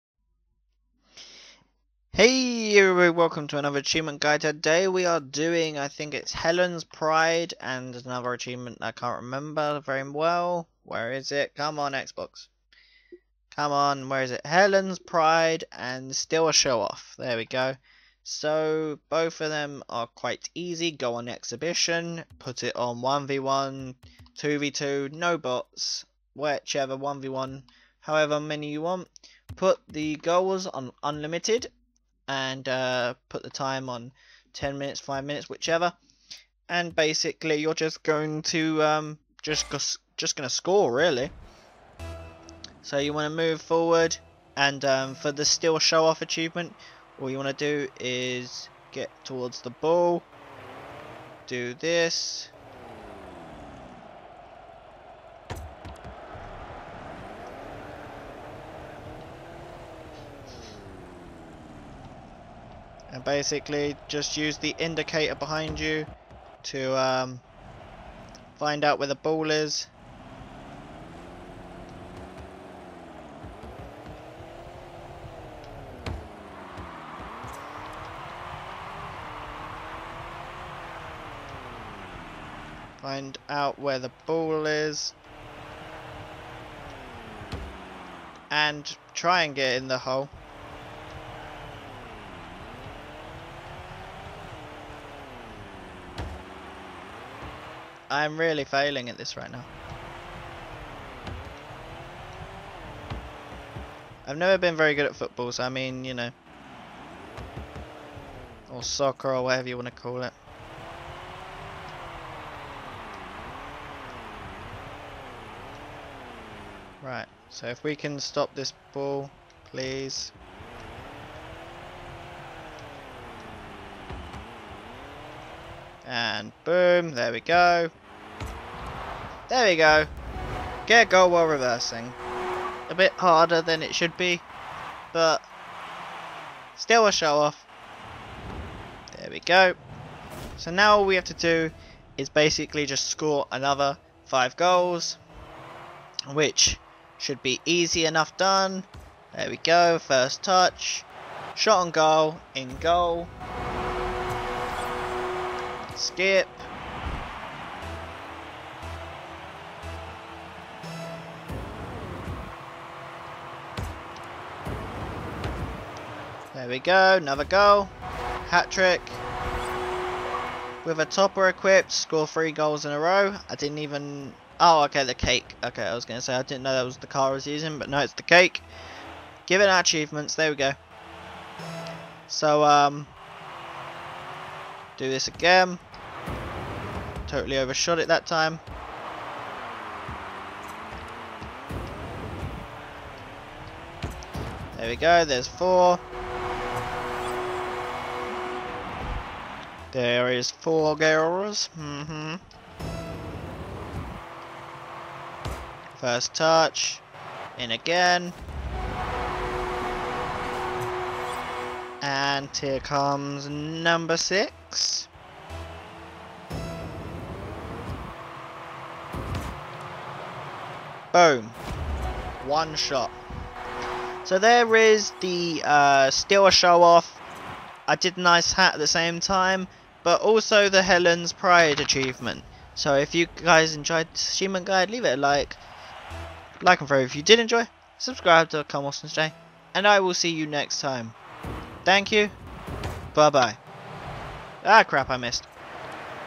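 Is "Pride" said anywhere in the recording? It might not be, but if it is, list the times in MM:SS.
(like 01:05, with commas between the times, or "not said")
00:06, 00:14, 03:51.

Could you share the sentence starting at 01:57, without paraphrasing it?
Right, so if we can stop this ball, please.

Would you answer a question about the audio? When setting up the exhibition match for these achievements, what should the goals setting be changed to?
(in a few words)
Unlimited.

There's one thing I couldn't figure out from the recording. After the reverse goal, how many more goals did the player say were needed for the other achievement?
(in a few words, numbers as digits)
5.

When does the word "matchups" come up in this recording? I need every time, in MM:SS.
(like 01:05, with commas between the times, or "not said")
not said.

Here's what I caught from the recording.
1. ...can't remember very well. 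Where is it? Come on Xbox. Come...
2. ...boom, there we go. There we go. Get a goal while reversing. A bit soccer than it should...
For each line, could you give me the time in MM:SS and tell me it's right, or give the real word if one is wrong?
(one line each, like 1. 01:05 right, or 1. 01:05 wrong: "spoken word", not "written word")
1. 00:08 right
2. 02:06 wrong: "harder", not "soccer".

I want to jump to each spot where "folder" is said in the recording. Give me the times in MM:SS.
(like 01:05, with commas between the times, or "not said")
not said.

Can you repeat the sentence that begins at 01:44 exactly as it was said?
I've never been very good at football, so I mean, you know.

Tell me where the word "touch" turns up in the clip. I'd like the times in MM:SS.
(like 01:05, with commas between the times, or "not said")
02:30, 03:26.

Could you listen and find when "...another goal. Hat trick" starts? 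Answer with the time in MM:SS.
02:47.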